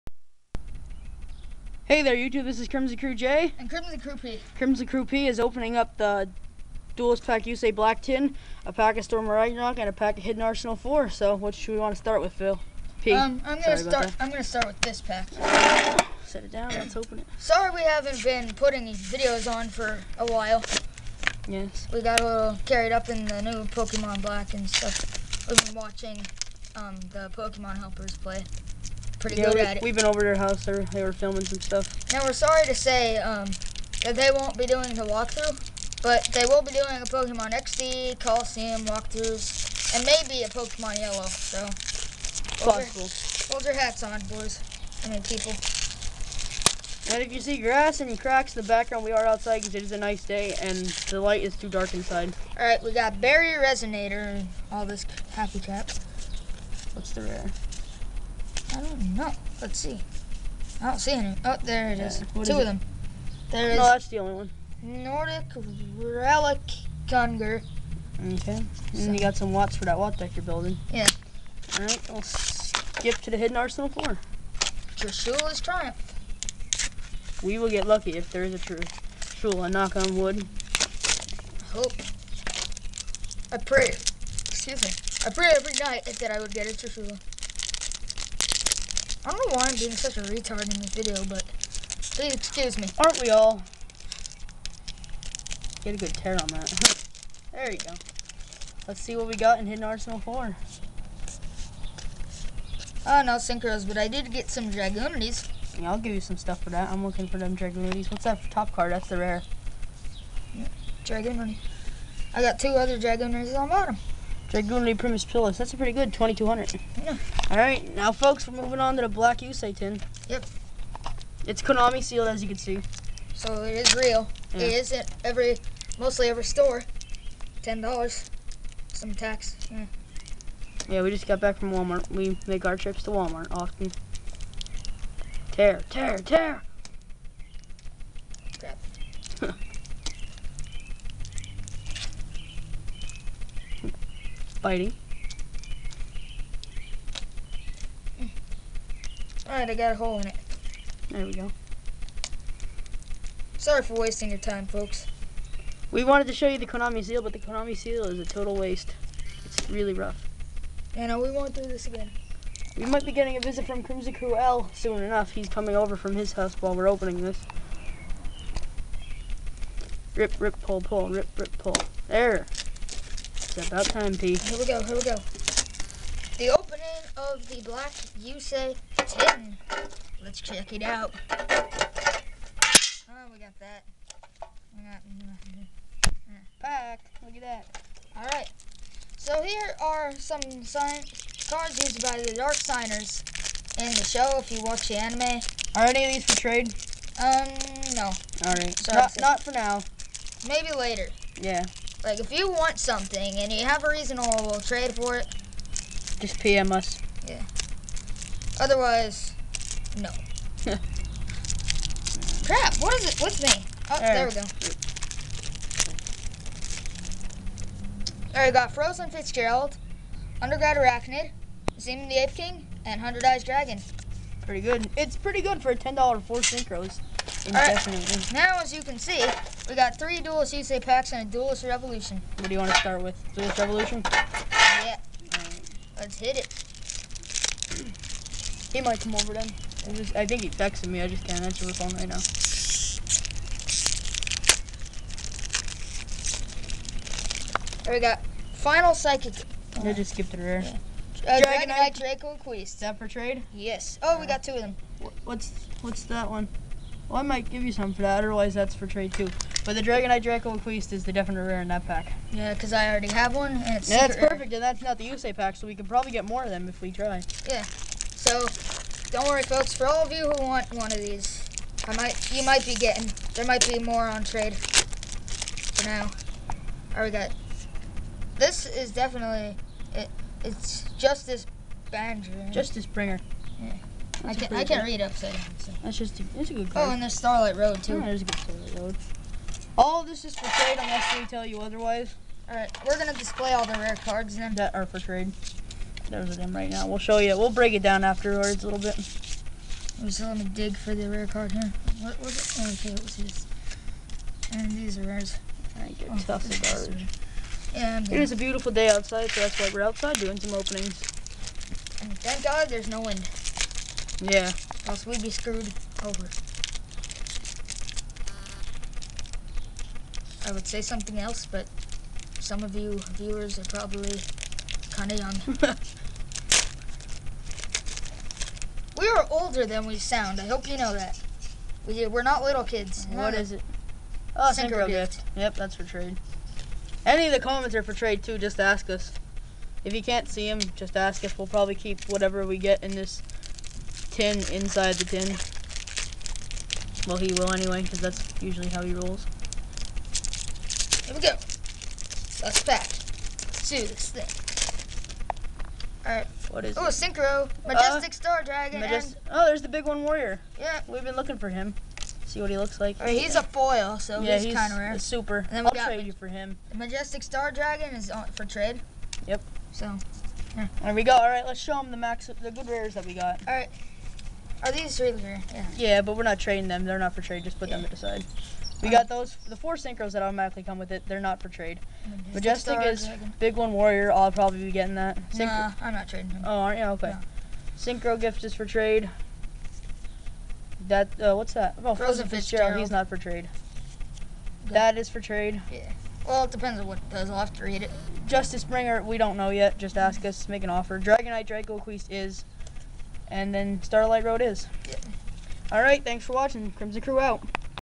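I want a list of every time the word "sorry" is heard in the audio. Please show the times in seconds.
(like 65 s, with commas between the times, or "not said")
17 s, 32 s, 153 s.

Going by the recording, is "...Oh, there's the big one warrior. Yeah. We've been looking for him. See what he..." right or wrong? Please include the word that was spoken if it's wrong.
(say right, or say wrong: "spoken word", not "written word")
right.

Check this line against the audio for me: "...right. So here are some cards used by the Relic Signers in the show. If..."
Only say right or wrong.
wrong.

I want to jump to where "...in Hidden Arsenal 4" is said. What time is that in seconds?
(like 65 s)
99 s.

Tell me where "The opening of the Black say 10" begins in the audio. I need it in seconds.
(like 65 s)
176 s.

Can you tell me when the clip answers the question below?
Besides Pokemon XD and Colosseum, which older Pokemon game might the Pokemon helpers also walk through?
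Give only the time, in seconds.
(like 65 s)
40 s.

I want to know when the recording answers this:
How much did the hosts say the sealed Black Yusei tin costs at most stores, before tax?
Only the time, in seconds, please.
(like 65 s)
127 s.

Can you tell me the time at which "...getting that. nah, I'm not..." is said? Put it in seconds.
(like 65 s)
384 s.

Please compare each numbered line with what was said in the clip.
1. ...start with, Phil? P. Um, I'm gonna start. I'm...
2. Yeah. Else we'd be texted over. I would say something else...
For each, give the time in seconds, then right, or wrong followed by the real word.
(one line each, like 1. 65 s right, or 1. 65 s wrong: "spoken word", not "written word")
1. 11 s right
2. 314 s wrong: "screwed", not "texted".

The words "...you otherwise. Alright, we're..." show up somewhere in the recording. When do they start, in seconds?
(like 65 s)
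291 s.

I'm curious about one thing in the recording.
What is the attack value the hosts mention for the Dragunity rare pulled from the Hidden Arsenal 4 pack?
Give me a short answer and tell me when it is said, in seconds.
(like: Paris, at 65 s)
2200, at 116 s.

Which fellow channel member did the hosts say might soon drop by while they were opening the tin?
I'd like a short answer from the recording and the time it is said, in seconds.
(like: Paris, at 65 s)
Crimson Crew L, at 163 s.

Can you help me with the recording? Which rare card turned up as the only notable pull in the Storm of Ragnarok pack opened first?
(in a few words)
Nordic Relic Gungnir.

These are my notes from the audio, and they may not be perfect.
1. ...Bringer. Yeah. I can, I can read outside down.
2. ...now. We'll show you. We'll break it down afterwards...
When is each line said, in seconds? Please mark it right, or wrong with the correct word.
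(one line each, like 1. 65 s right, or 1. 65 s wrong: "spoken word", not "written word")
1. 282 s wrong: "upside", not "outside"
2. 296 s right.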